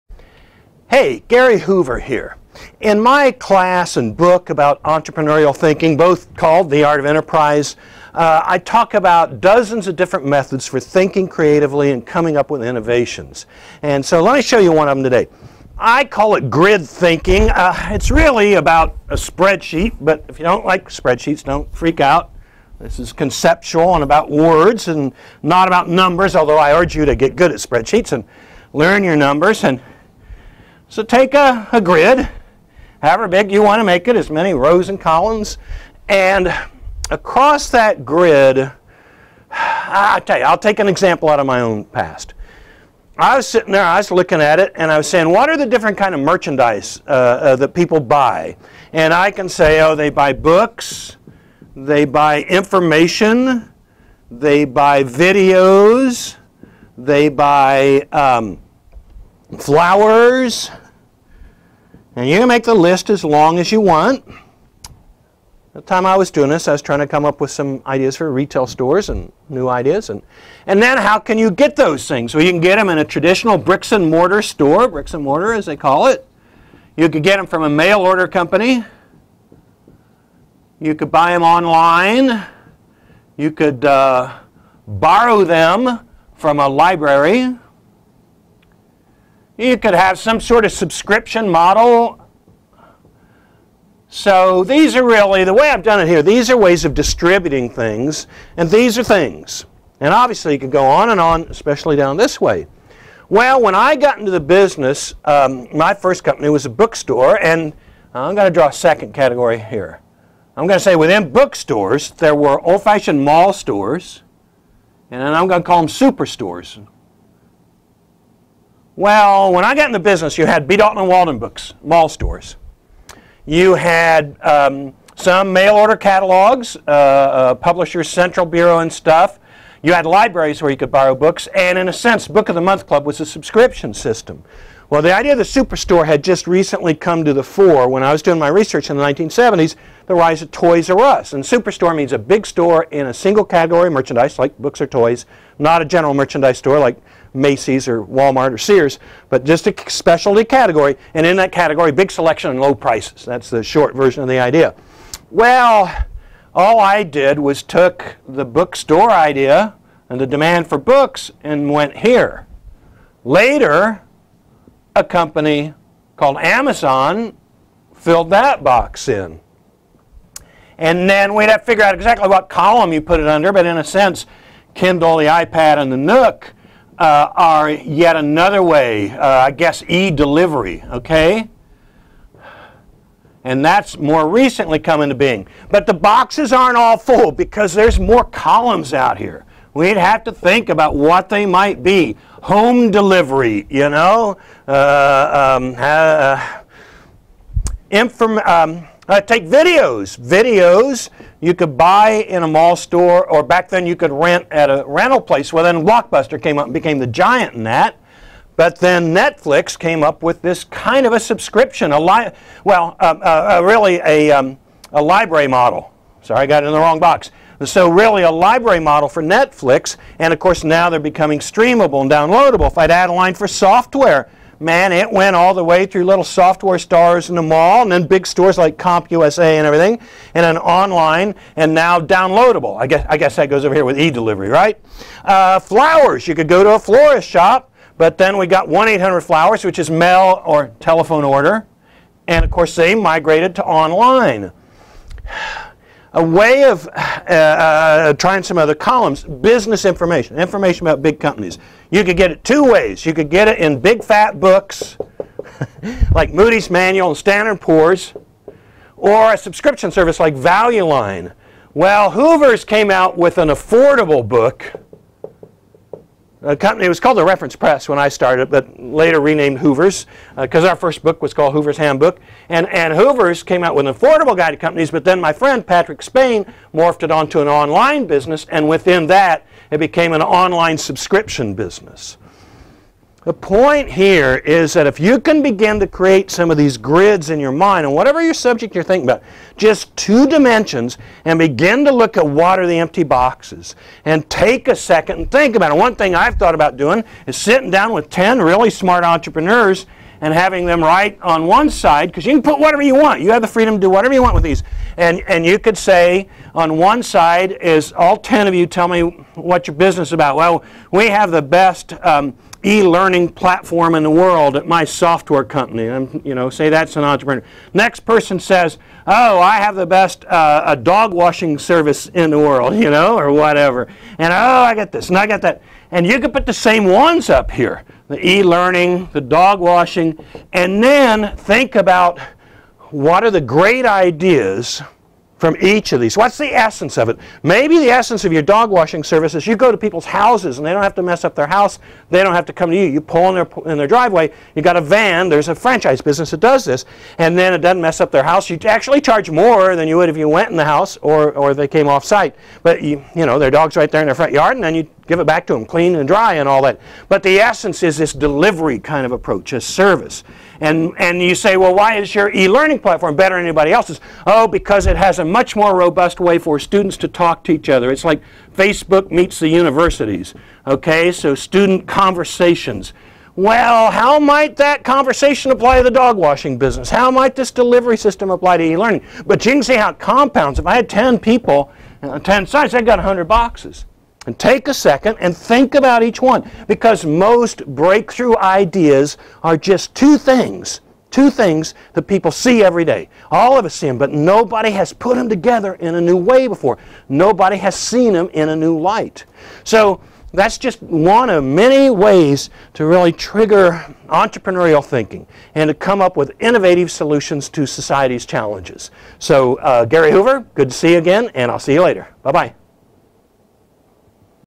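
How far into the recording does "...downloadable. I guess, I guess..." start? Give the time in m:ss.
3:52.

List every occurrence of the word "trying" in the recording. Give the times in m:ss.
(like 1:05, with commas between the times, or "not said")
1:06, 4:08.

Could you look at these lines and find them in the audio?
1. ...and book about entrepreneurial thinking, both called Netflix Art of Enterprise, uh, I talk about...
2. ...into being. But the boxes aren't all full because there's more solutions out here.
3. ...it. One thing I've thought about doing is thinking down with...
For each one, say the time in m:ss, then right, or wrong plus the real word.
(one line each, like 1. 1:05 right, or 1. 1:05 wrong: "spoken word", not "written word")
1. 0:03 wrong: "The", not "Netflix"
2. 3:05 wrong: "columns", not "solutions"
3. 4:55 wrong: "sitting", not "thinking".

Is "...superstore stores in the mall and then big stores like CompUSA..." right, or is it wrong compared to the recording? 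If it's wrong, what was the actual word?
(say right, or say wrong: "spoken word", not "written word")
wrong: "software", not "superstore".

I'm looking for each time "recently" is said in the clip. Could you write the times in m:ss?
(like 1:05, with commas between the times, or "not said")
2:16, 3:04.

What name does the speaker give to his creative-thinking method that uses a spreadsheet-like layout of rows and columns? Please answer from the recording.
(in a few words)
grid thinking.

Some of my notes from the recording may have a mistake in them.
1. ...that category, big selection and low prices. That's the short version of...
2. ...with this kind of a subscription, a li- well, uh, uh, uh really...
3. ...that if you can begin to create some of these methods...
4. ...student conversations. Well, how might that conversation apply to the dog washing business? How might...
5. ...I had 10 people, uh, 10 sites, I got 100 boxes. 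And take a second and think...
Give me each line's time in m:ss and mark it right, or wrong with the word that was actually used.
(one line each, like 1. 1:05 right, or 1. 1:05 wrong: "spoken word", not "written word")
1. 2:31 right
2. 3:30 right
3. 4:44 wrong: "grids", not "methods"
4. 6:11 right
5. 6:20 right.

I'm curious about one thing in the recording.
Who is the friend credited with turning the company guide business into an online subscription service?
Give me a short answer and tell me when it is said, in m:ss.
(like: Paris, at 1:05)
Patrick Spain, at 4:35.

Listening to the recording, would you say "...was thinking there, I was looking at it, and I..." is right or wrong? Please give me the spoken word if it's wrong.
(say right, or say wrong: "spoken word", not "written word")
wrong: "sitting", not "thinking".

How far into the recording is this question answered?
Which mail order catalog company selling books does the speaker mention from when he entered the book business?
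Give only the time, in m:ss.
2:07.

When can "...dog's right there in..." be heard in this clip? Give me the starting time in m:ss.
5:53.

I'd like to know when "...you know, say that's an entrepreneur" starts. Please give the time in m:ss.
5:16.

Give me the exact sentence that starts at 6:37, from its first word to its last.
Nobody has seen them in a new light.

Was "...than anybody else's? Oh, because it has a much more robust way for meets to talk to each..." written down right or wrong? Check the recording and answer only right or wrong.
wrong.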